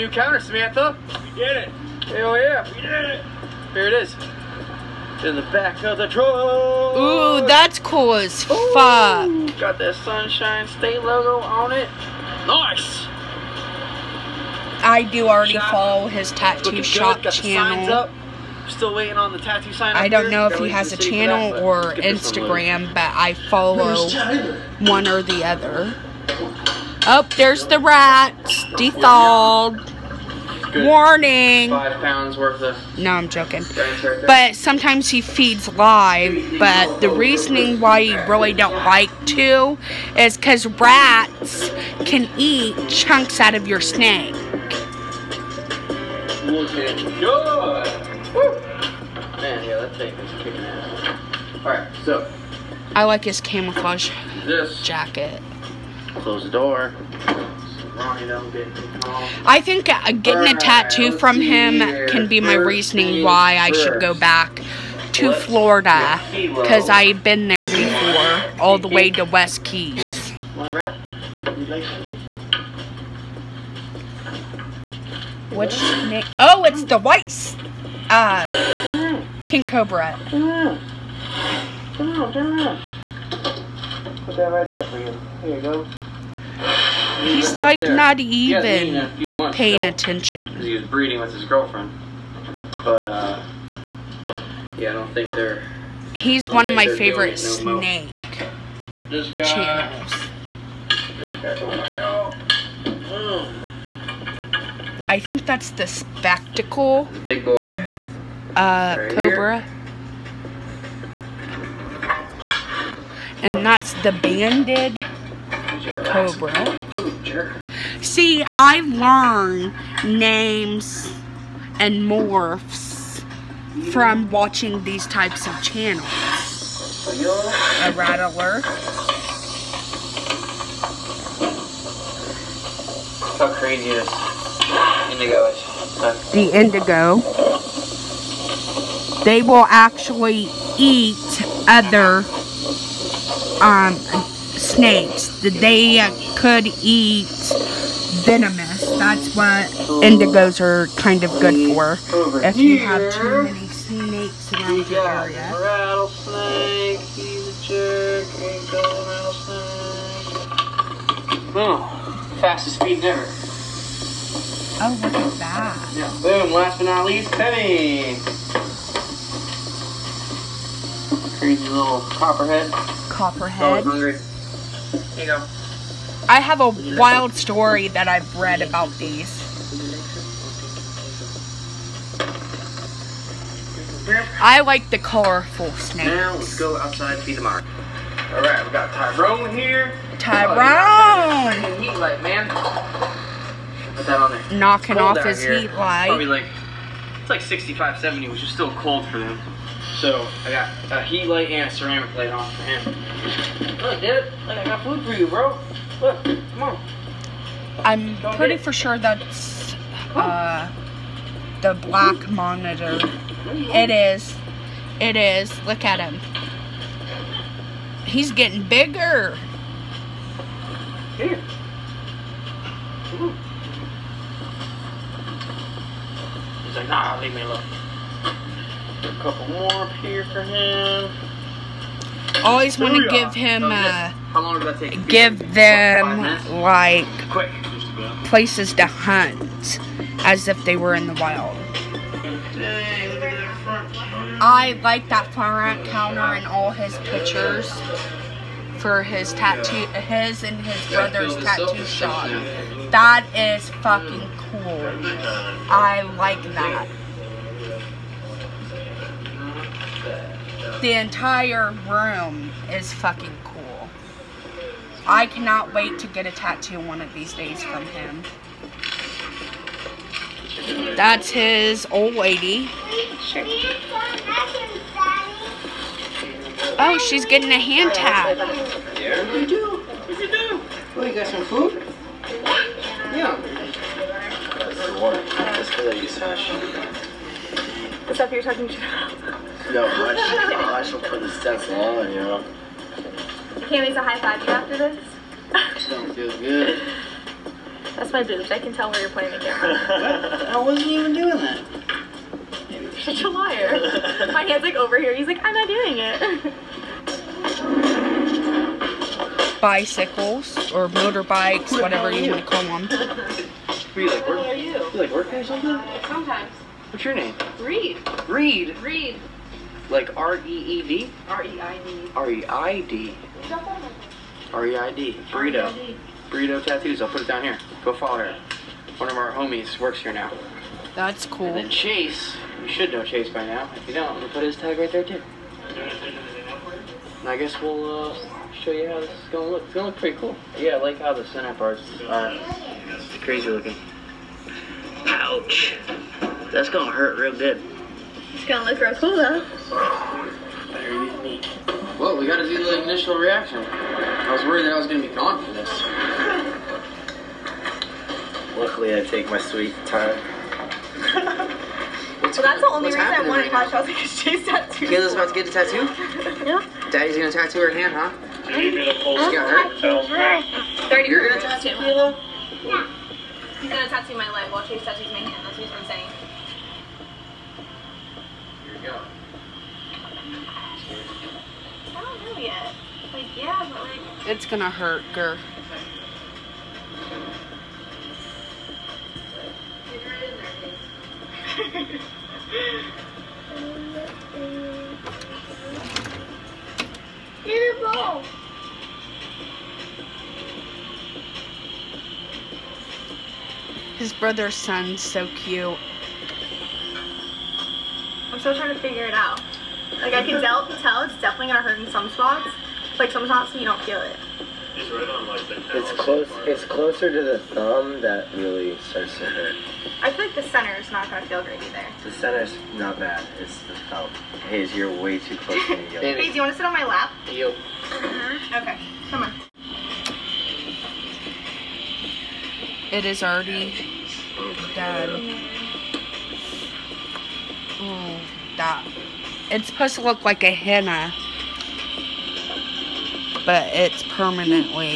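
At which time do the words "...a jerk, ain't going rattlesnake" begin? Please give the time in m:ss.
2:37.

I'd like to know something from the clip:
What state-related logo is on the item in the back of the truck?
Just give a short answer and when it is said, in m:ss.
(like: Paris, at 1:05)
Sunshine State, at 0:10.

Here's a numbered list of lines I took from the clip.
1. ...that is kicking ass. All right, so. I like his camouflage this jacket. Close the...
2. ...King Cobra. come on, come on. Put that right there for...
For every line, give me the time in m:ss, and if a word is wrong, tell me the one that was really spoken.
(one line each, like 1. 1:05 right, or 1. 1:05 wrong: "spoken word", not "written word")
1. 0:49 right
2. 1:19 right.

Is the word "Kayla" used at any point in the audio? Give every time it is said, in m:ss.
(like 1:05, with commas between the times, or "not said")
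6:04, 6:11.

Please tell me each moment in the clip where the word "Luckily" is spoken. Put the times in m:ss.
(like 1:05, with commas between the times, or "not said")
5:58.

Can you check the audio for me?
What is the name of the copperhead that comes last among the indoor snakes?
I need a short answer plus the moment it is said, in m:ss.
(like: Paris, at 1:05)
Penny, at 2:47.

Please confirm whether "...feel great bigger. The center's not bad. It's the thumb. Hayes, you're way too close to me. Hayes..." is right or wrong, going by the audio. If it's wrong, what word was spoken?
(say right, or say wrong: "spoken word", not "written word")
wrong: "either", not "bigger".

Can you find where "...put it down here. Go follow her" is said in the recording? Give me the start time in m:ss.
5:27.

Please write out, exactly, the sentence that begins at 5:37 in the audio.
And I guess we'll uh, show you how this is gonna look.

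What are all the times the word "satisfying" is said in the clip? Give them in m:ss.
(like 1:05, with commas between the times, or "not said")
not said.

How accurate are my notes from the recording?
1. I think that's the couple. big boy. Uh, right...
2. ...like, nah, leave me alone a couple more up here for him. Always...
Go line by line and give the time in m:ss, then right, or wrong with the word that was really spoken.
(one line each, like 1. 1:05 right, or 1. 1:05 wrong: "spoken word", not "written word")
1. 1:45 wrong: "spectacle", not "couple"
2. 3:46 right.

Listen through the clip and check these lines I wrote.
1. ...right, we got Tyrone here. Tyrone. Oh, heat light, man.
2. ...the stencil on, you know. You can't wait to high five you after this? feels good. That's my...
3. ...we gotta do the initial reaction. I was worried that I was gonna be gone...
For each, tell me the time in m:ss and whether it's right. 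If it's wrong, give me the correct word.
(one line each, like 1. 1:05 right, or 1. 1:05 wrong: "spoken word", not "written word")
1. 3:08 right
2. 4:51 right
3. 5:52 right.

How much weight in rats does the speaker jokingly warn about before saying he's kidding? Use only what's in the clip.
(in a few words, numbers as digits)
5 pounds.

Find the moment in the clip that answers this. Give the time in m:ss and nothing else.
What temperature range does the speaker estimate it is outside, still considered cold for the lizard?
3:17.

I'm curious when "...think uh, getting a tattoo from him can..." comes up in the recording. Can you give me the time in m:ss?
0:59.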